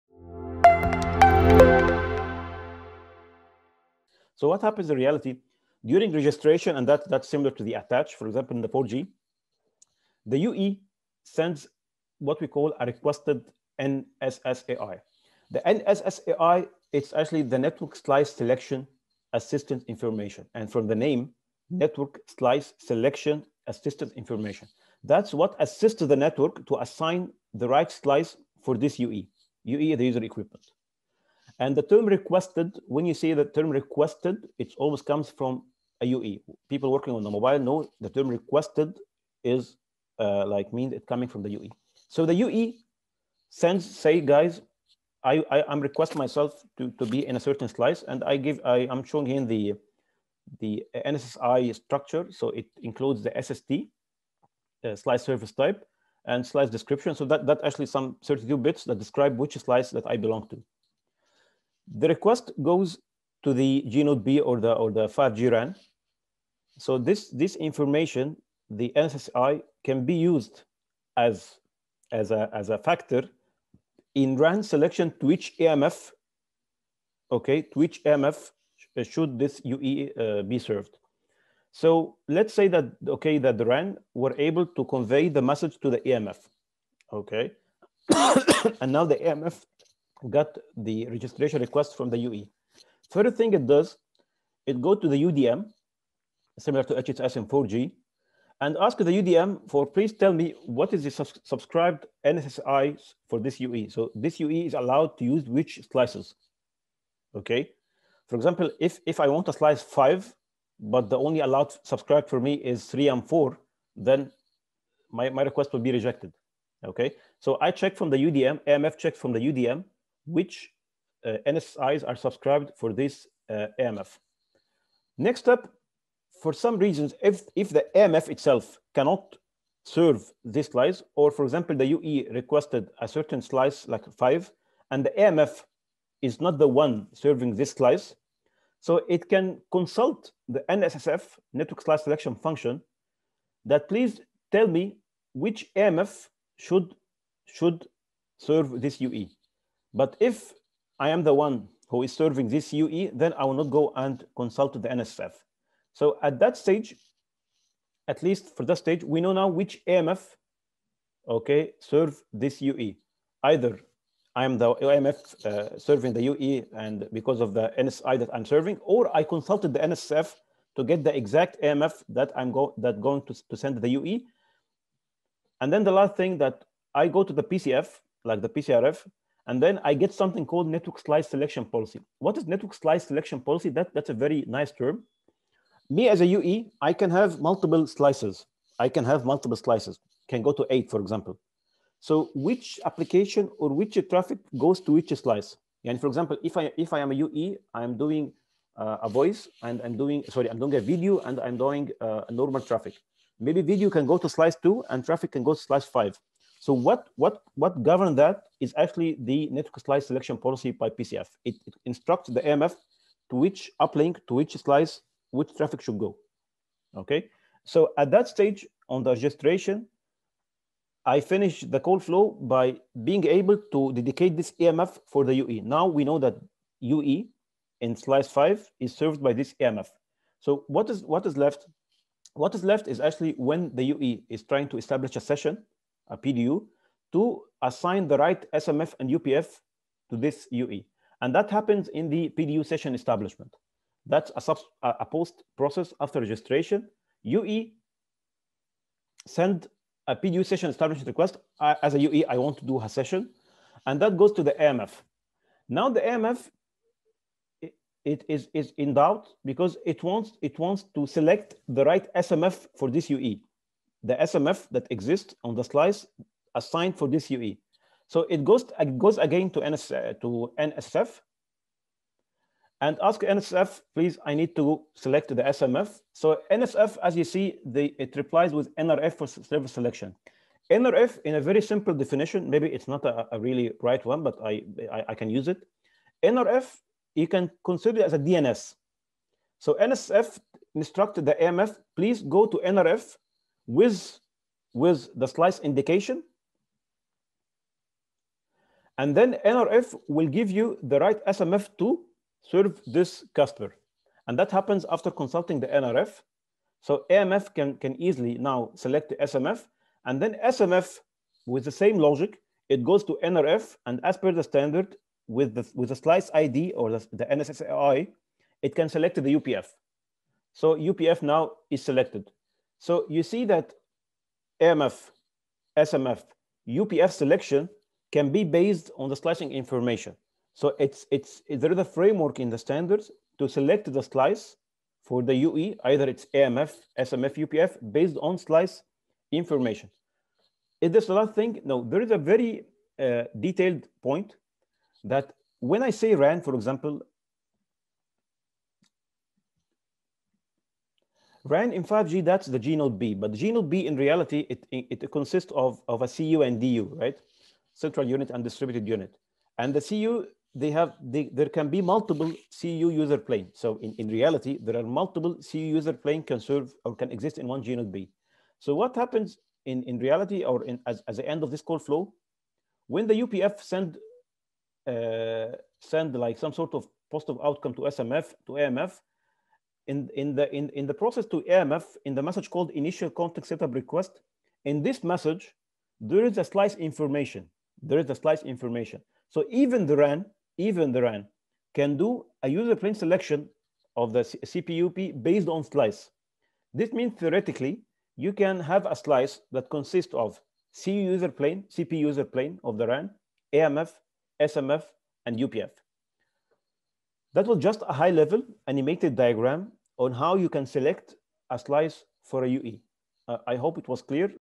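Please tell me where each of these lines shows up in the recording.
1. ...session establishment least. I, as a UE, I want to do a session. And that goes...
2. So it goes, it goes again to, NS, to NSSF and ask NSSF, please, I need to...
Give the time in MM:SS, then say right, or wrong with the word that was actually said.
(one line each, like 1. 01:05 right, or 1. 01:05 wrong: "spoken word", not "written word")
1. 04:10 wrong: "request", not "least"
2. 04:28 right.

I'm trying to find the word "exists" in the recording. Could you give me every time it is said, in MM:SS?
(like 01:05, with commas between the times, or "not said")
04:24, 06:07.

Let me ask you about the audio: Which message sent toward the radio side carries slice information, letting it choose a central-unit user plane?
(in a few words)
Initial context setup request.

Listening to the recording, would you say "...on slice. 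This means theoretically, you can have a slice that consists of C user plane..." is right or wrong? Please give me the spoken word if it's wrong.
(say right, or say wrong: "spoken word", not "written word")
right.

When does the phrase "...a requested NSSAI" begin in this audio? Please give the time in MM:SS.
00:12.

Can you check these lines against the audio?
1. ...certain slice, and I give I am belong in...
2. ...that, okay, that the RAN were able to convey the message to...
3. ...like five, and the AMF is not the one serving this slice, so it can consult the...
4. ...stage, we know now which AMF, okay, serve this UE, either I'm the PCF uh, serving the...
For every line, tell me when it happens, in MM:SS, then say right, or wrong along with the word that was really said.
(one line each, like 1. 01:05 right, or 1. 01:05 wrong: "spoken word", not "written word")
1. 00:47 wrong: "showing", not "belong"
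2. 01:22 right
3. 02:13 right
4. 02:38 wrong: "AMF", not "PCF".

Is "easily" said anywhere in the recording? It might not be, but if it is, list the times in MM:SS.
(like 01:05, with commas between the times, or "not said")
05:08.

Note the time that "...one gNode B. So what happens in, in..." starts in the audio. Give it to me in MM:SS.
06:07.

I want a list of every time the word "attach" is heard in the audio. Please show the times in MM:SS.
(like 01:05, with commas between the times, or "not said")
00:07.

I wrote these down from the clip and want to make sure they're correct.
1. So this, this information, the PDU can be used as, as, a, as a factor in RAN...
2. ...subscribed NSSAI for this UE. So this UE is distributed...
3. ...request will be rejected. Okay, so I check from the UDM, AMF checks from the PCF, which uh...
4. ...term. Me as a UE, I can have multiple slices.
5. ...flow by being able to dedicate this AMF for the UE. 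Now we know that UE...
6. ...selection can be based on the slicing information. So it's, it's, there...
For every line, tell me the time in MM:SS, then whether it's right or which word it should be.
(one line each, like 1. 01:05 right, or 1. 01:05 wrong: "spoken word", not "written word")
1. 01:06 wrong: "NSSAI", not "PDU"
2. 01:41 wrong: "allowed", not "distributed"
3. 01:55 wrong: "UDM", not "PCF"
4. 03:04 right
5. 03:41 right
6. 05:27 right.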